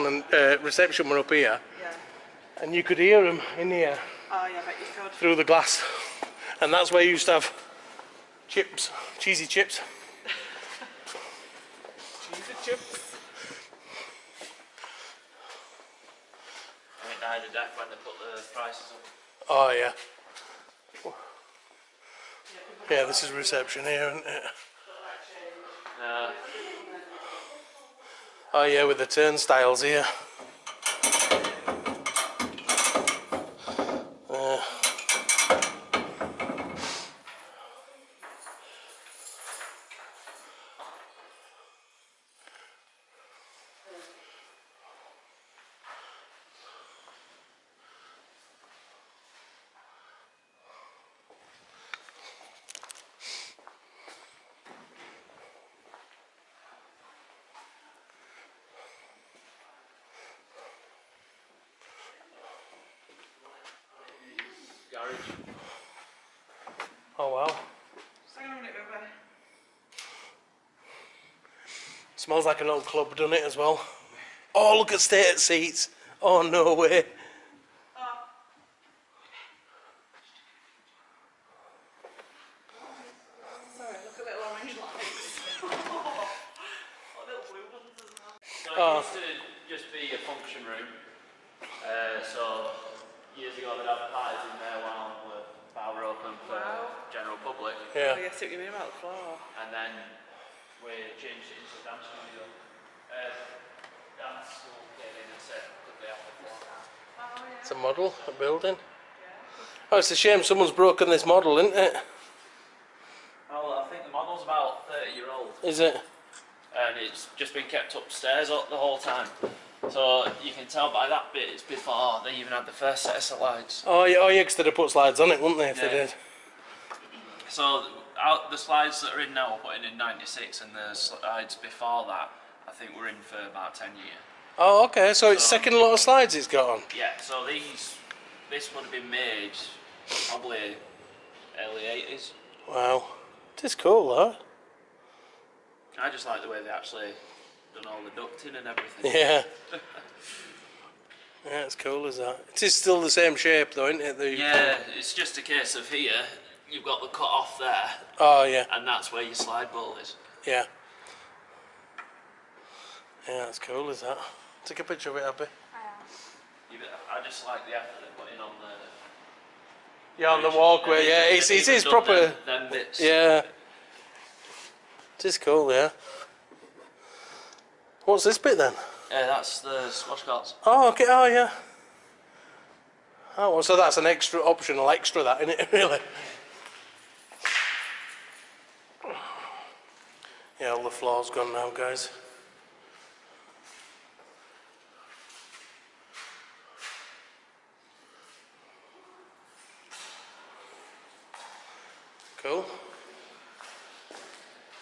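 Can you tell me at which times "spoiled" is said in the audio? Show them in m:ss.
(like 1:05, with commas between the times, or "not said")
not said.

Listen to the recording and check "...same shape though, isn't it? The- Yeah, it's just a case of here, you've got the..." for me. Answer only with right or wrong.
right.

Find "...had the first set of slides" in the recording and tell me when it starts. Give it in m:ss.
2:02.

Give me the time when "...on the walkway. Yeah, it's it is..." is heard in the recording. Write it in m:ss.
2:50.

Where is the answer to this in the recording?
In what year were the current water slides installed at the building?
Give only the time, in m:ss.
2:09.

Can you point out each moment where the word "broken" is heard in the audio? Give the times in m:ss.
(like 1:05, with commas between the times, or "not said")
1:50.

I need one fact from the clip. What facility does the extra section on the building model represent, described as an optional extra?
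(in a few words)
squash courts.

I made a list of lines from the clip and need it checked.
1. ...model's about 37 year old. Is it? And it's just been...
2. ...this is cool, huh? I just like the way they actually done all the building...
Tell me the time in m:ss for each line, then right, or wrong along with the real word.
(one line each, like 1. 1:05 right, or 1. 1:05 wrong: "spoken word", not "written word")
1. 1:54 wrong: "30", not "37"
2. 2:23 wrong: "ducting", not "building".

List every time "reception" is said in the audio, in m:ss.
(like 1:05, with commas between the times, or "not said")
0:00, 0:23.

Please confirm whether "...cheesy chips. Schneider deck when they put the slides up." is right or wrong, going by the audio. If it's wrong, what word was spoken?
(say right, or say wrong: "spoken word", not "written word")
wrong: "prices", not "slides".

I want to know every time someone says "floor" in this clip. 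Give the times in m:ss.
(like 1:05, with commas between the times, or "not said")
3:10.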